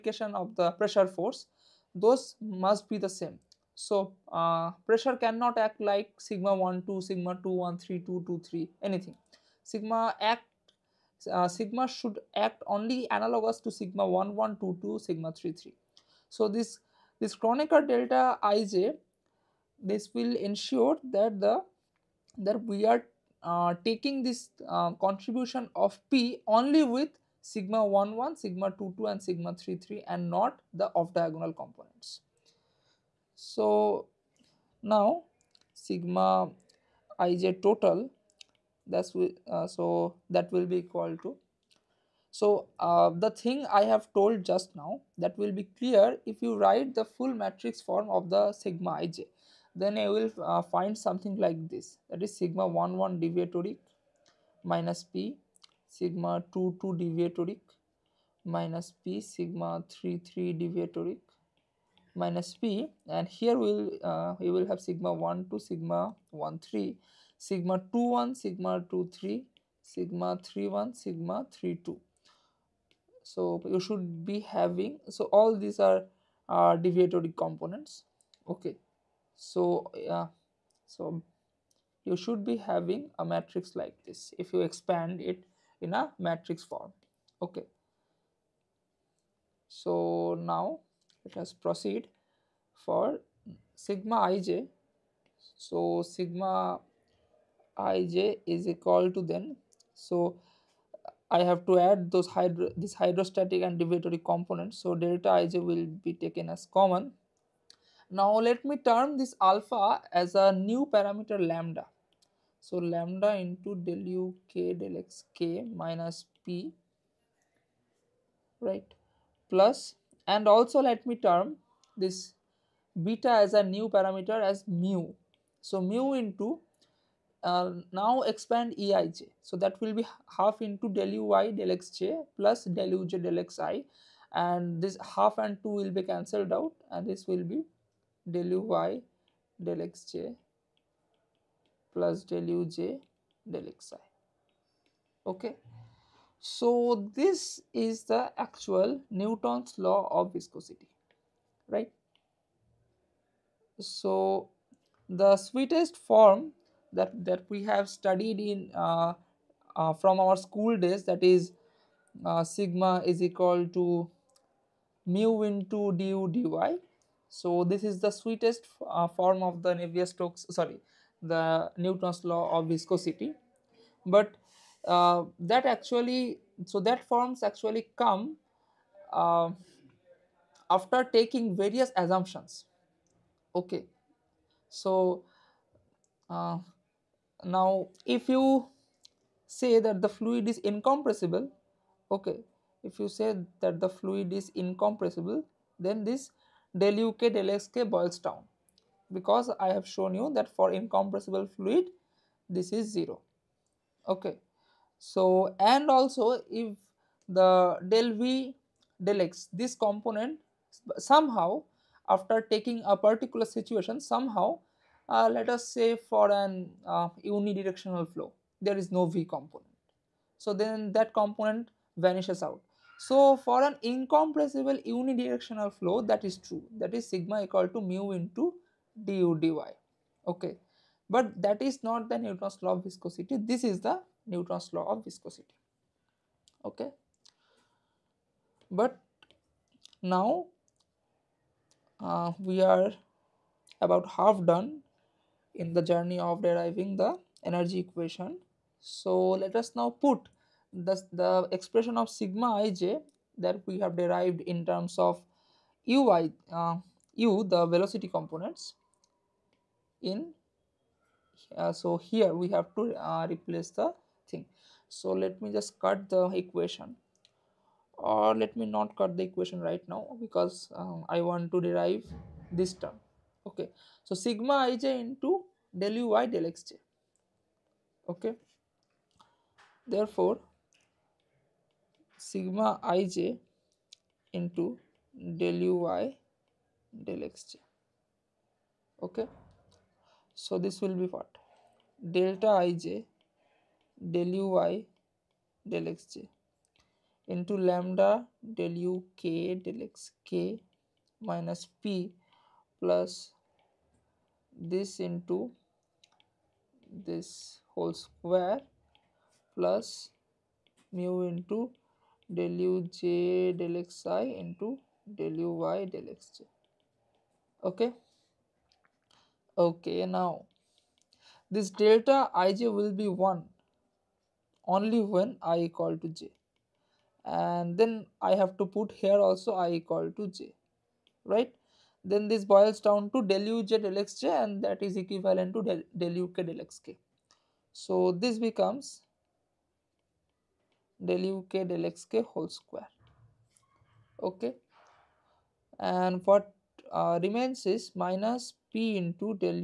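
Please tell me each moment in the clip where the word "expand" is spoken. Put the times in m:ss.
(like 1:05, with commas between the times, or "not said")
1:24, 2:08.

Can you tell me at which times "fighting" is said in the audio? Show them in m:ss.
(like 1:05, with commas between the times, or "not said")
not said.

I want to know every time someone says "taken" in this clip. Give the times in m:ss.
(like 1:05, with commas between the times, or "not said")
1:46.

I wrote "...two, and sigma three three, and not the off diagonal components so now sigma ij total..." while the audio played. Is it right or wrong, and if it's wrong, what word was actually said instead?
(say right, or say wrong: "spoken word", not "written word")
right.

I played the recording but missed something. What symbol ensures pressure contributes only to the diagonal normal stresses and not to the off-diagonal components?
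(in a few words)
Kronecker delta ij.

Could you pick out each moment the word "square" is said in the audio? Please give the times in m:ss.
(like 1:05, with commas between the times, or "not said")
5:07, 5:42.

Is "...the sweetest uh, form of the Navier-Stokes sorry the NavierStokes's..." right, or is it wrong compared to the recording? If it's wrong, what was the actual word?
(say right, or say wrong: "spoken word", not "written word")
wrong: "Newton", not "NavierStokes".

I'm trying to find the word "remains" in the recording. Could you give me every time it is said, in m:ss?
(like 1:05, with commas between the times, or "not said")
5:47.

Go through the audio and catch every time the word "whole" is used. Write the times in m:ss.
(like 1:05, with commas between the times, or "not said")
5:07, 5:42.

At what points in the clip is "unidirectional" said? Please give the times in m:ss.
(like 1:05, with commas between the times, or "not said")
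3:37, 3:44.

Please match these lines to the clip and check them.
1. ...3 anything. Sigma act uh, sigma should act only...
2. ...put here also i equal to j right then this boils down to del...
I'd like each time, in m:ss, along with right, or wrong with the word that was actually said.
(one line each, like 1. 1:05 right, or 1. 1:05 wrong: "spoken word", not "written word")
1. 0:08 right
2. 5:28 right.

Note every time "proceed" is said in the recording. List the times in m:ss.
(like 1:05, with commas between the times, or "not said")
1:31.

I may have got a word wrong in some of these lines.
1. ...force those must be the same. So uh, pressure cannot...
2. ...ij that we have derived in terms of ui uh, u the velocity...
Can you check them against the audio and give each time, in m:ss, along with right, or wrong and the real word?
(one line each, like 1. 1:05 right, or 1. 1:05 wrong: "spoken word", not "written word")
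1. 0:01 right
2. 4:12 right.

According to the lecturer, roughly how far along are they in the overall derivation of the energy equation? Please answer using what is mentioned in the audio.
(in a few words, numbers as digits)
about half done.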